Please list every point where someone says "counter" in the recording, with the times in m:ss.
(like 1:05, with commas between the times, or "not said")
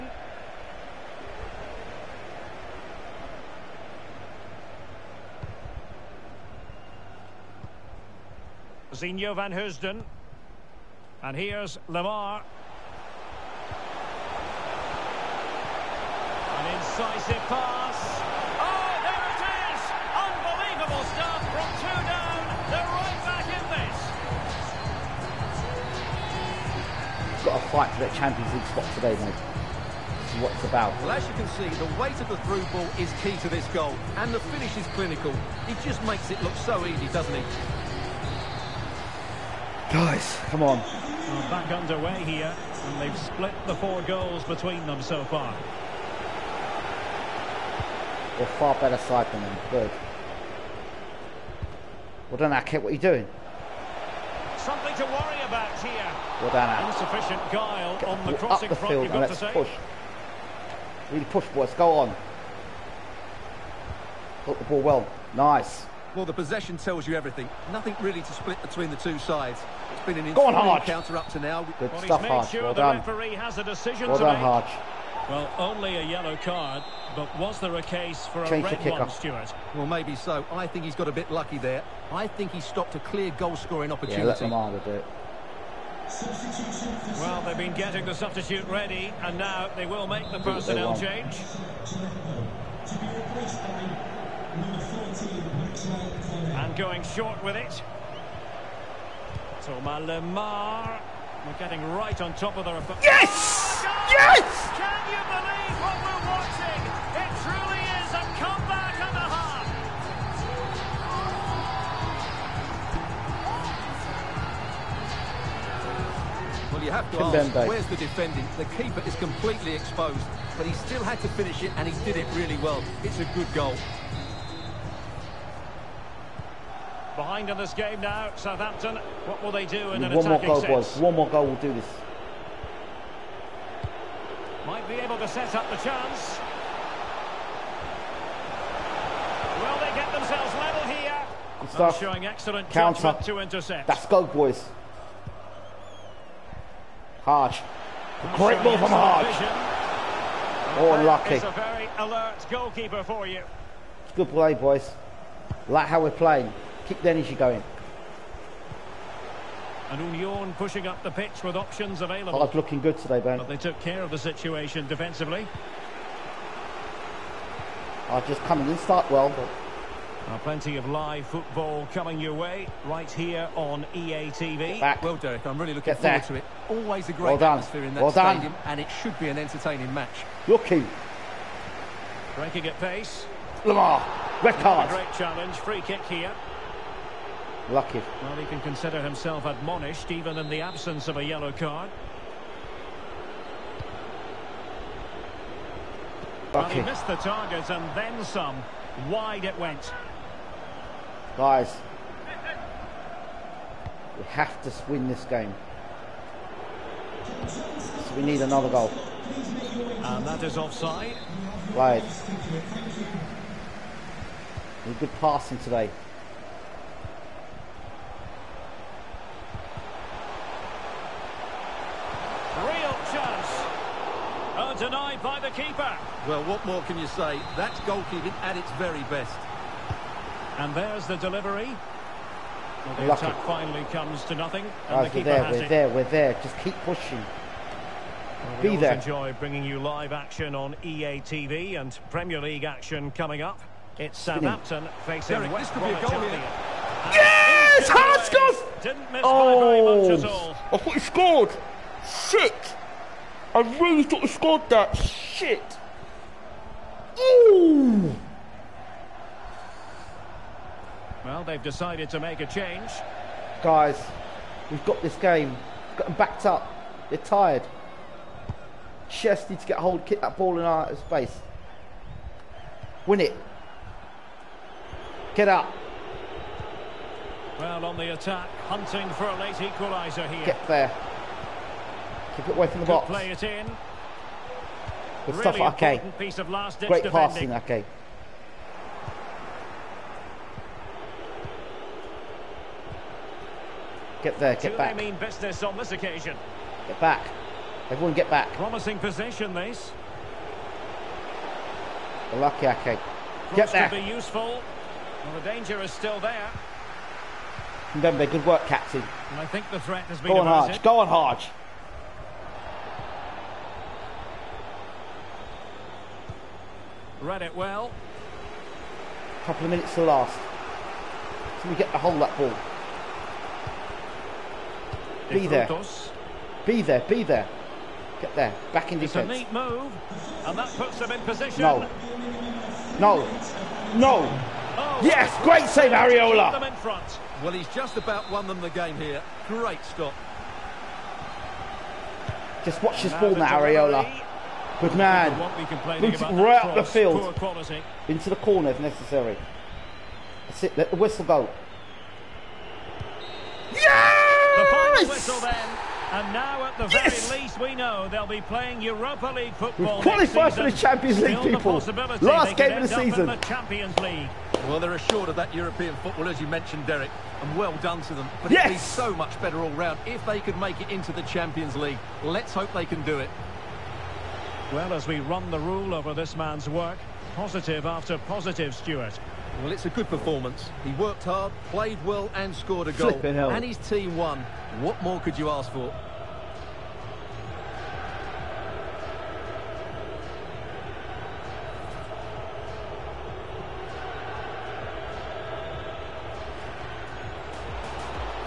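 1:10, 2:22.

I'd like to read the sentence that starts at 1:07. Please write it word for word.
Nothing really to split between the two sides.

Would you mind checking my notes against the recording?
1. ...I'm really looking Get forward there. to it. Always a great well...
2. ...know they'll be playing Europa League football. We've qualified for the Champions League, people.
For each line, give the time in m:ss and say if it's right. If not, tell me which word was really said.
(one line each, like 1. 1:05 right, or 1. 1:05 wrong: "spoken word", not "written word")
1. 2:55 right
2. 5:57 right.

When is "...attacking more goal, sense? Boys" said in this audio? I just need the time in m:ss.
2:10.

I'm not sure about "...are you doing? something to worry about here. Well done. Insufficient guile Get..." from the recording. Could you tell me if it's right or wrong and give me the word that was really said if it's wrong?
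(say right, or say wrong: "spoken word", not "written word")
right.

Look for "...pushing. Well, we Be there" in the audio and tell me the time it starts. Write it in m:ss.
3:56.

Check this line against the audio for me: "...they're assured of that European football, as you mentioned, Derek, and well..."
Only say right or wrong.
right.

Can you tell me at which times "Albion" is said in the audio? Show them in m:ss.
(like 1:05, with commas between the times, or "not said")
4:06.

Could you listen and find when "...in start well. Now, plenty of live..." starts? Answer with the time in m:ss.
2:48.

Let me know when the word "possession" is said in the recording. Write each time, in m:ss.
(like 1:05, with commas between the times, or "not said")
1:06, 4:58.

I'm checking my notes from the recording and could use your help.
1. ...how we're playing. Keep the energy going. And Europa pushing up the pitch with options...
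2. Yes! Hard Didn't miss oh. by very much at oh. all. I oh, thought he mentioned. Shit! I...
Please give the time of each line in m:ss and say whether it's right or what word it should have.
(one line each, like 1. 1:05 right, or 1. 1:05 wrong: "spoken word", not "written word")
1. 2:35 wrong: "Union", not "Europa"
2. 4:07 wrong: "scored", not "mentioned".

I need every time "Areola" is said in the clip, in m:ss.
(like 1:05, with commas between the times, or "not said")
5:35, 5:43.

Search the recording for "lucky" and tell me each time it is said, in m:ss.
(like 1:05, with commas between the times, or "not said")
1:21, 2:31, 3:07, 3:53, 5:02.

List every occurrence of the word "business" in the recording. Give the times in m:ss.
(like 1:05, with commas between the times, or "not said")
4:55.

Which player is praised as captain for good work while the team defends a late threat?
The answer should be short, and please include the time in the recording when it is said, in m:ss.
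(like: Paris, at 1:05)
Mbembe, at 5:07.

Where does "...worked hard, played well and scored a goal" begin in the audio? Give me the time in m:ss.
6:20.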